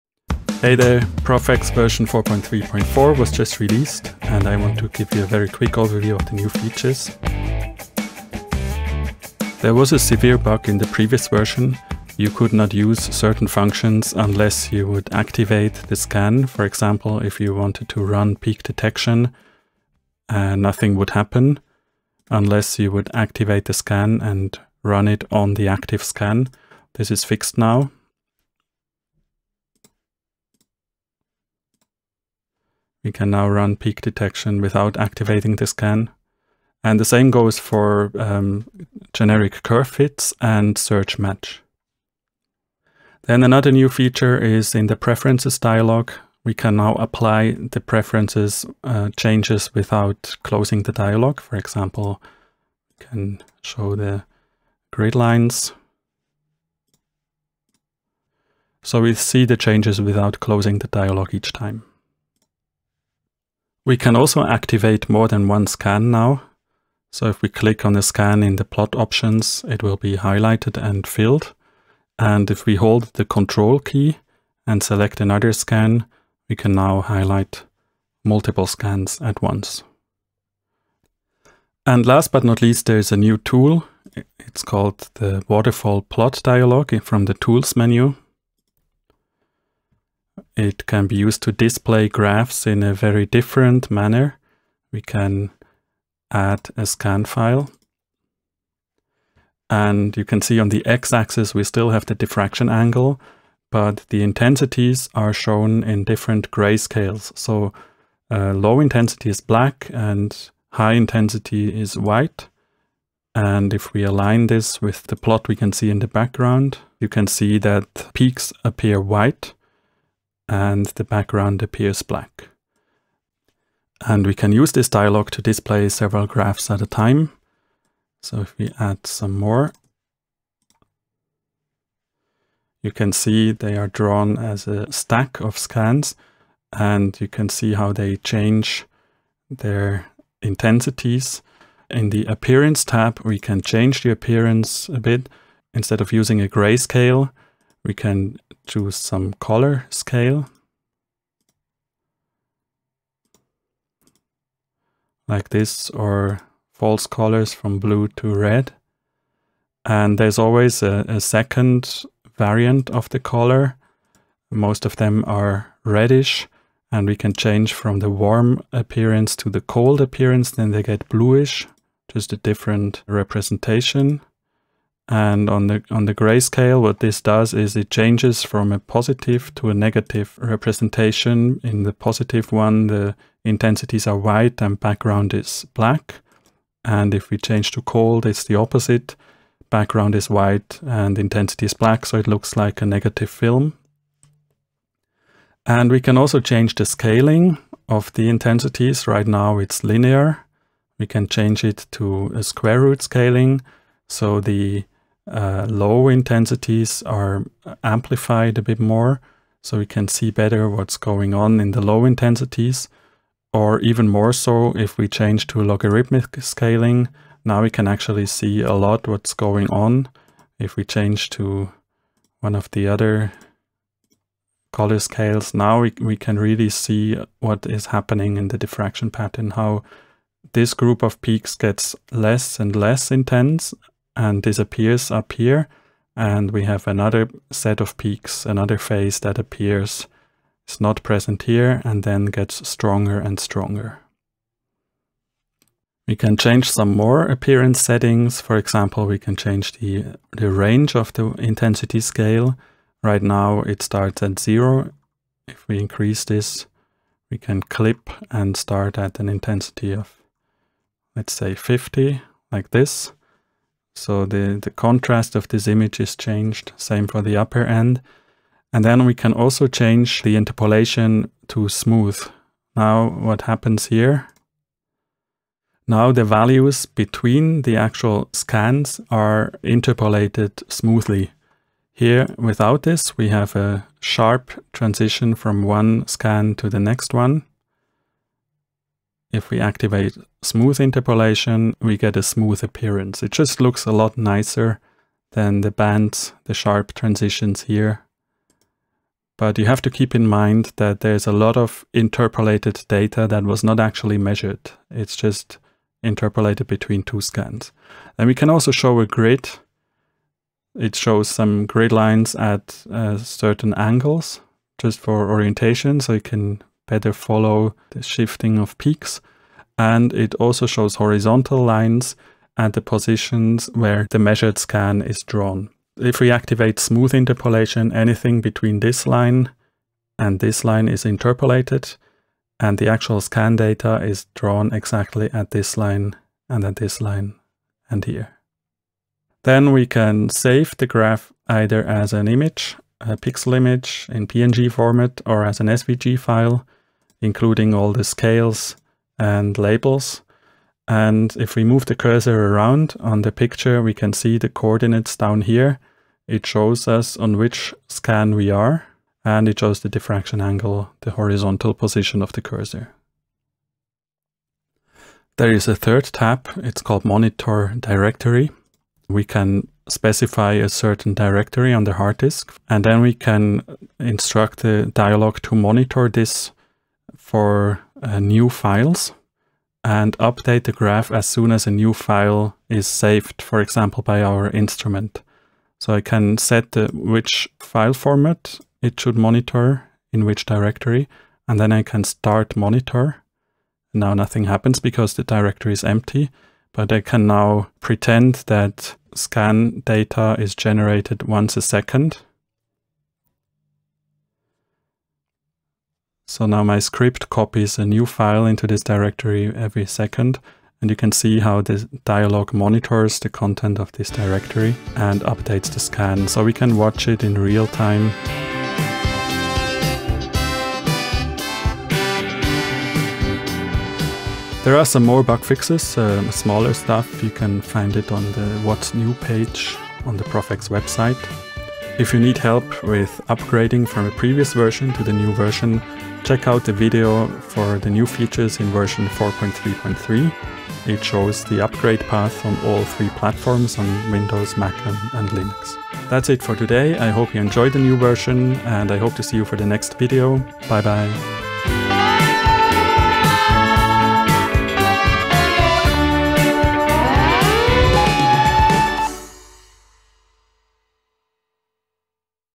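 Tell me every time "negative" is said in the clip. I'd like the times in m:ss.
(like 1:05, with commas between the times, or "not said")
2:59, 3:12.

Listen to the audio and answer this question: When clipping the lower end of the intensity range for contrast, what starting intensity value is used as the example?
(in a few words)
50.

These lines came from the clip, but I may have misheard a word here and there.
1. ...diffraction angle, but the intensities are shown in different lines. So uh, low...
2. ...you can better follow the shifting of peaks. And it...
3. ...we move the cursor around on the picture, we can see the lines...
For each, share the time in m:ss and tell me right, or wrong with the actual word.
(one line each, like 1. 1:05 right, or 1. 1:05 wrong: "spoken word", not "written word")
1. 1:42 wrong: "grayscales", not "lines"
2. 5:16 right
3. 5:51 wrong: "coordinates", not "lines".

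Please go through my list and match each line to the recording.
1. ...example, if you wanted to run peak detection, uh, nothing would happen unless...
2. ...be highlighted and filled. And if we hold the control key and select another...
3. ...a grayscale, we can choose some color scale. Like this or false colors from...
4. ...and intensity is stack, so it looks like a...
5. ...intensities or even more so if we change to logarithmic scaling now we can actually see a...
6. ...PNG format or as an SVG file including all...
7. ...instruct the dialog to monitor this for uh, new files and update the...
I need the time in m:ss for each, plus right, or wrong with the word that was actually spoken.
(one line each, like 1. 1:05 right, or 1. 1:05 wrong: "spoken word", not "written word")
1. 0:16 right
2. 1:09 right
3. 2:26 right
4. 3:10 wrong: "black", not "stack"
5. 3:32 right
6. 5:44 right
7. 6:13 right.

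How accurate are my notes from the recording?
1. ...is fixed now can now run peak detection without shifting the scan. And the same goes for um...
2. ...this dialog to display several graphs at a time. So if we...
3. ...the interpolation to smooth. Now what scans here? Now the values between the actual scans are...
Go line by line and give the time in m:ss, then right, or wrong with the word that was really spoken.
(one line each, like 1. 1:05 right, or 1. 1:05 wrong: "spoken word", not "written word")
1. 0:27 wrong: "activating", not "shifting"
2. 2:04 right
3. 4:30 wrong: "happens", not "scans".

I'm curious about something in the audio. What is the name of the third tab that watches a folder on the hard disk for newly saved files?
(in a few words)
Monitor Directory.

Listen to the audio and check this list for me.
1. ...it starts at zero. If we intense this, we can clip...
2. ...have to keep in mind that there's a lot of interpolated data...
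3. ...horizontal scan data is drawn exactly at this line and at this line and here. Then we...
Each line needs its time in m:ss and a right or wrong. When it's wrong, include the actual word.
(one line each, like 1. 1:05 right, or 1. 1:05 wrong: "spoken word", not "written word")
1. 4:13 wrong: "increase", not "intense"
2. 4:59 right
3. 5:32 wrong: "actual", not "horizontal".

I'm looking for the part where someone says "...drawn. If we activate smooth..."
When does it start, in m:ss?
5:25.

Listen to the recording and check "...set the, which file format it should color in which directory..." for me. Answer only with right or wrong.
wrong.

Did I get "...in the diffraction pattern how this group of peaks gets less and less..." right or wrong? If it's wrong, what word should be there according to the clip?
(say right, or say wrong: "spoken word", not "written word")
right.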